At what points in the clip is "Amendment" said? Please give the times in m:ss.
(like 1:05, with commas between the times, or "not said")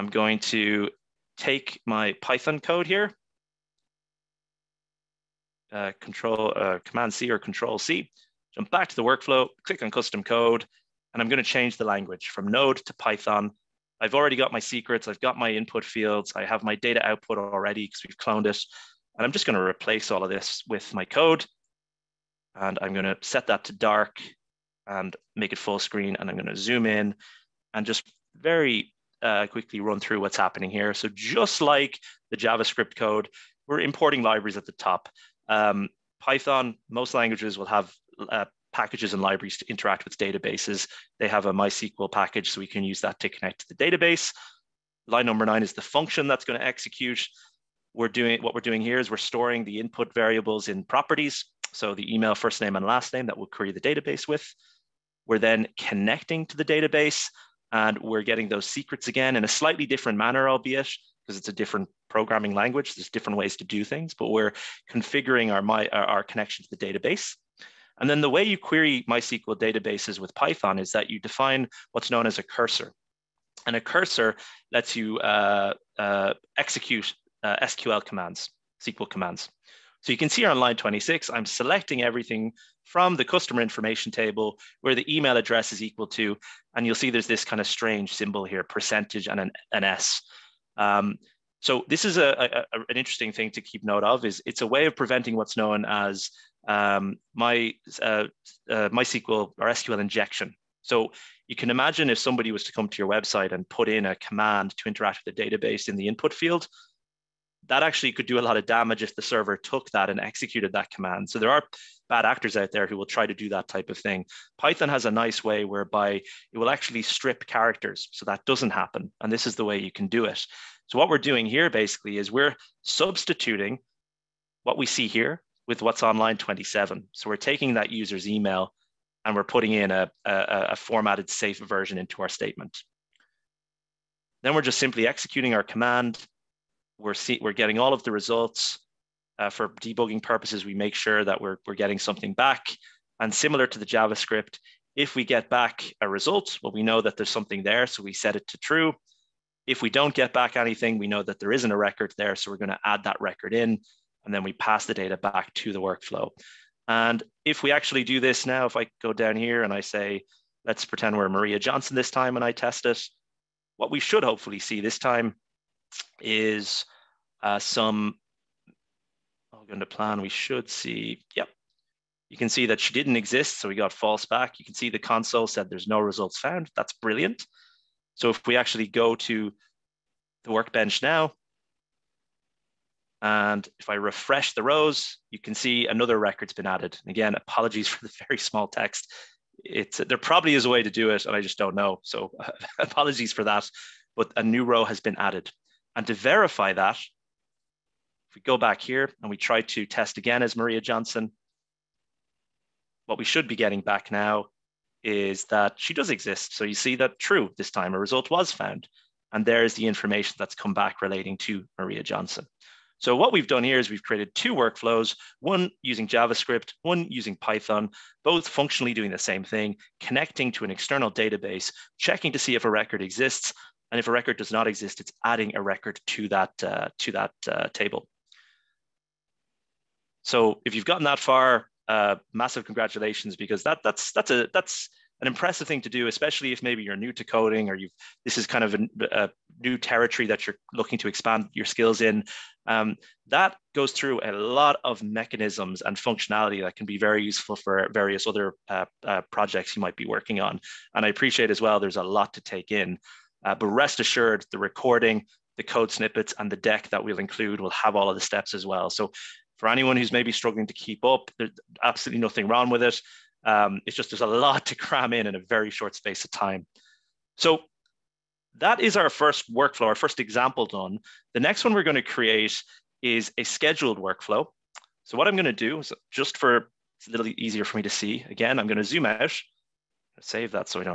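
not said.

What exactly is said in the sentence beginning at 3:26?
So you see that true this time, a result was found.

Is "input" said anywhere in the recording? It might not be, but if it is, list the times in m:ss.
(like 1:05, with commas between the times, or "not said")
0:15, 0:49, 1:46.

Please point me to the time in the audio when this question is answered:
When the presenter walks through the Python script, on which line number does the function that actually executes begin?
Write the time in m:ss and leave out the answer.
0:45.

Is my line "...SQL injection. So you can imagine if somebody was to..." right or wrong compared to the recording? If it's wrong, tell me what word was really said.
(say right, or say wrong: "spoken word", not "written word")
right.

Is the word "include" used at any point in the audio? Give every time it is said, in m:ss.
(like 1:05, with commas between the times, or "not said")
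4:17.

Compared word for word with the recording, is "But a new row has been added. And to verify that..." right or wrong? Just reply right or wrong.
right.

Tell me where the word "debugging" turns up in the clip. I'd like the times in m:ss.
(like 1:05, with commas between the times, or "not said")
2:19.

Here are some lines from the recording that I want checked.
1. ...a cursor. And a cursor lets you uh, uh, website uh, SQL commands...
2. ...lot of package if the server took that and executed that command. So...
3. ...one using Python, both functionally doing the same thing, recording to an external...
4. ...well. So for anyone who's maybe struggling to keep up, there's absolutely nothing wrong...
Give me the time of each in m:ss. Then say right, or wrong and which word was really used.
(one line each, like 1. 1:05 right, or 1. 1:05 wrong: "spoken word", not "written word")
1. 1:12 wrong: "execute", not "website"
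2. 1:48 wrong: "damage", not "package"
3. 3:36 wrong: "connecting", not "recording"
4. 4:18 right.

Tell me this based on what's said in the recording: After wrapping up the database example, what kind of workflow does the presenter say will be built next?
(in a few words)
scheduled workflow.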